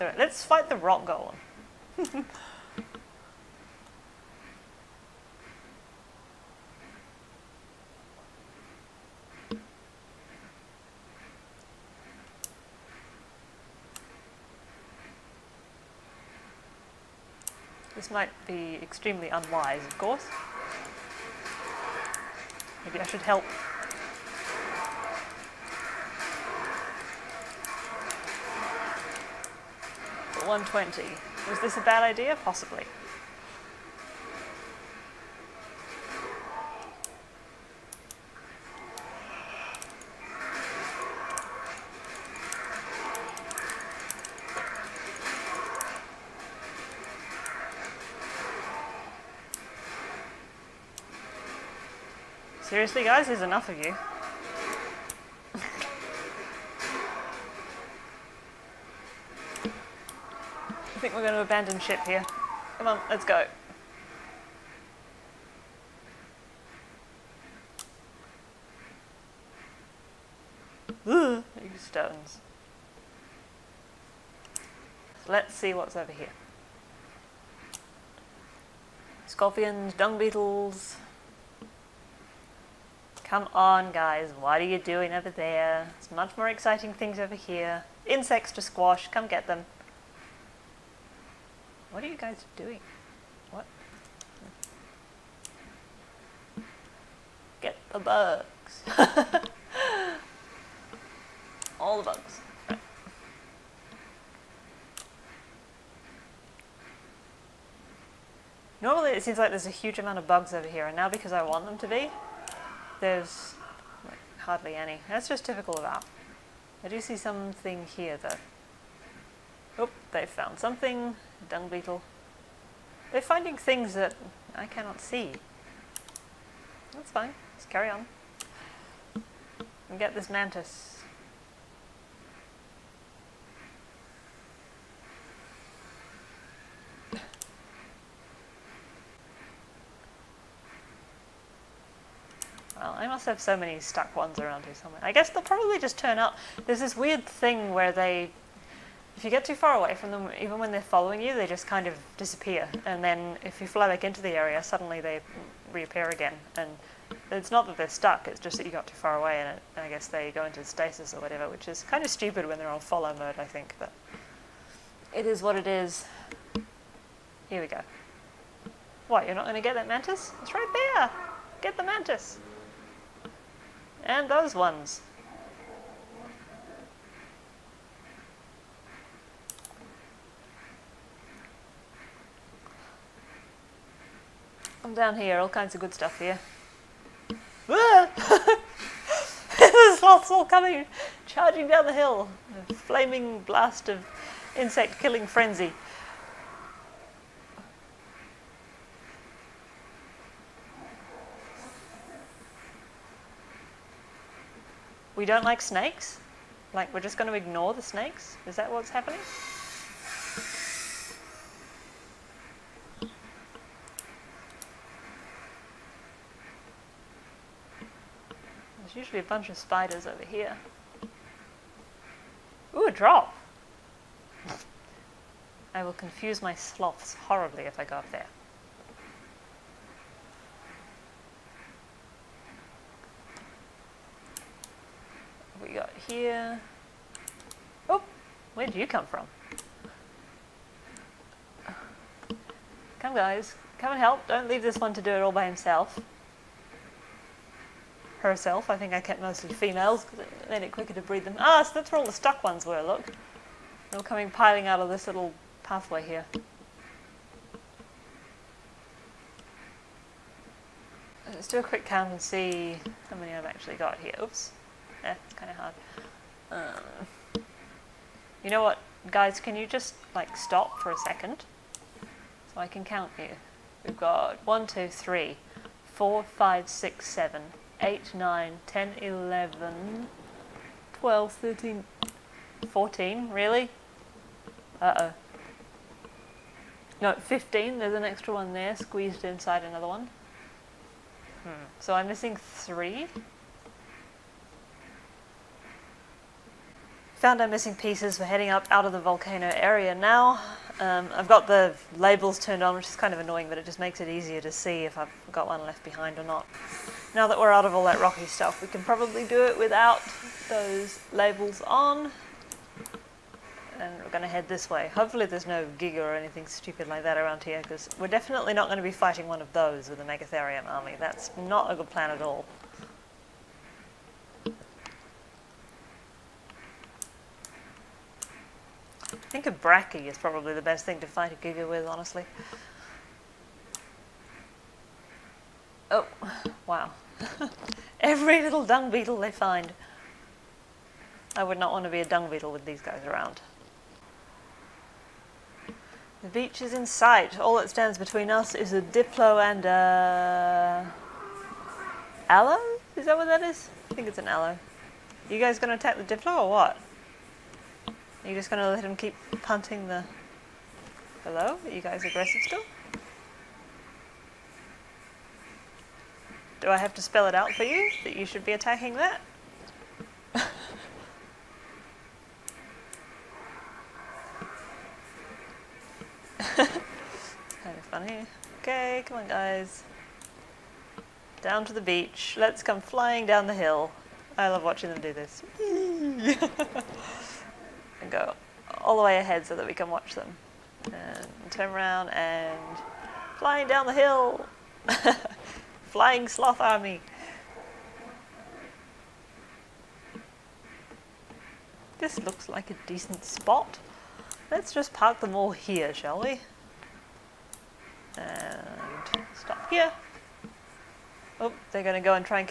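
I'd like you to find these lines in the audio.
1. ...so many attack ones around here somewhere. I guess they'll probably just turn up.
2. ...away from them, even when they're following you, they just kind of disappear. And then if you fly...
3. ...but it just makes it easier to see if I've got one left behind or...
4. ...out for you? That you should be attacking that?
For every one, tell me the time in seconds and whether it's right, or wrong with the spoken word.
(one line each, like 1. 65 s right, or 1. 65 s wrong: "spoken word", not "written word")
1. 143 s wrong: "stuck", not "attack"
2. 149 s right
3. 303 s right
4. 367 s right.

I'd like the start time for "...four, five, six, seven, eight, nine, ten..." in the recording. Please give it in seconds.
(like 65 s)
275 s.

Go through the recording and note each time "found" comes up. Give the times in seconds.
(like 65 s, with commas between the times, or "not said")
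120 s, 297 s.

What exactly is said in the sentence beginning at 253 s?
They're coming piling out of this little pathway here.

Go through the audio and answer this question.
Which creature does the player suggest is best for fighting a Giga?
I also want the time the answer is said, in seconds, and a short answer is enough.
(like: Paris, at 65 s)
brachy, at 329 s.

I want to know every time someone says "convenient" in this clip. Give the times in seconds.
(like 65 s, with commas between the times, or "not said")
not said.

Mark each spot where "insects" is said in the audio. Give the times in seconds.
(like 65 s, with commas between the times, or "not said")
88 s, 194 s.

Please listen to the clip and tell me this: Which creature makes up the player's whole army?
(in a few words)
Megatherium.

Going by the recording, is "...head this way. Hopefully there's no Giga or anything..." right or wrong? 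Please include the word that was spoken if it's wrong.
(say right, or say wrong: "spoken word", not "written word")
right.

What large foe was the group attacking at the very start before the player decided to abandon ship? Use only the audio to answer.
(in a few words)
rock golem.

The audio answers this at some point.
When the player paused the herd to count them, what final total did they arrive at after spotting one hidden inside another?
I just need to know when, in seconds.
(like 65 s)
287 s.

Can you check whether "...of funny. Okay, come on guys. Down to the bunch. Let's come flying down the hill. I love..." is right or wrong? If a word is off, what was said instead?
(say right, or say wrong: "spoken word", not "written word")
wrong: "beach", not "bunch".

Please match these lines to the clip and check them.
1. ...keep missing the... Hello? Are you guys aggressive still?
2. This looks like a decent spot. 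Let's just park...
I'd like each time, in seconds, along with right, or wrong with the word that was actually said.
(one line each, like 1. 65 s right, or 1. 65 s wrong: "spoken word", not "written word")
1. 358 s wrong: "punting", not "missing"
2. 401 s right.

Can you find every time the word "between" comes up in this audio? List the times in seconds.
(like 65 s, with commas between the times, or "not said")
347 s.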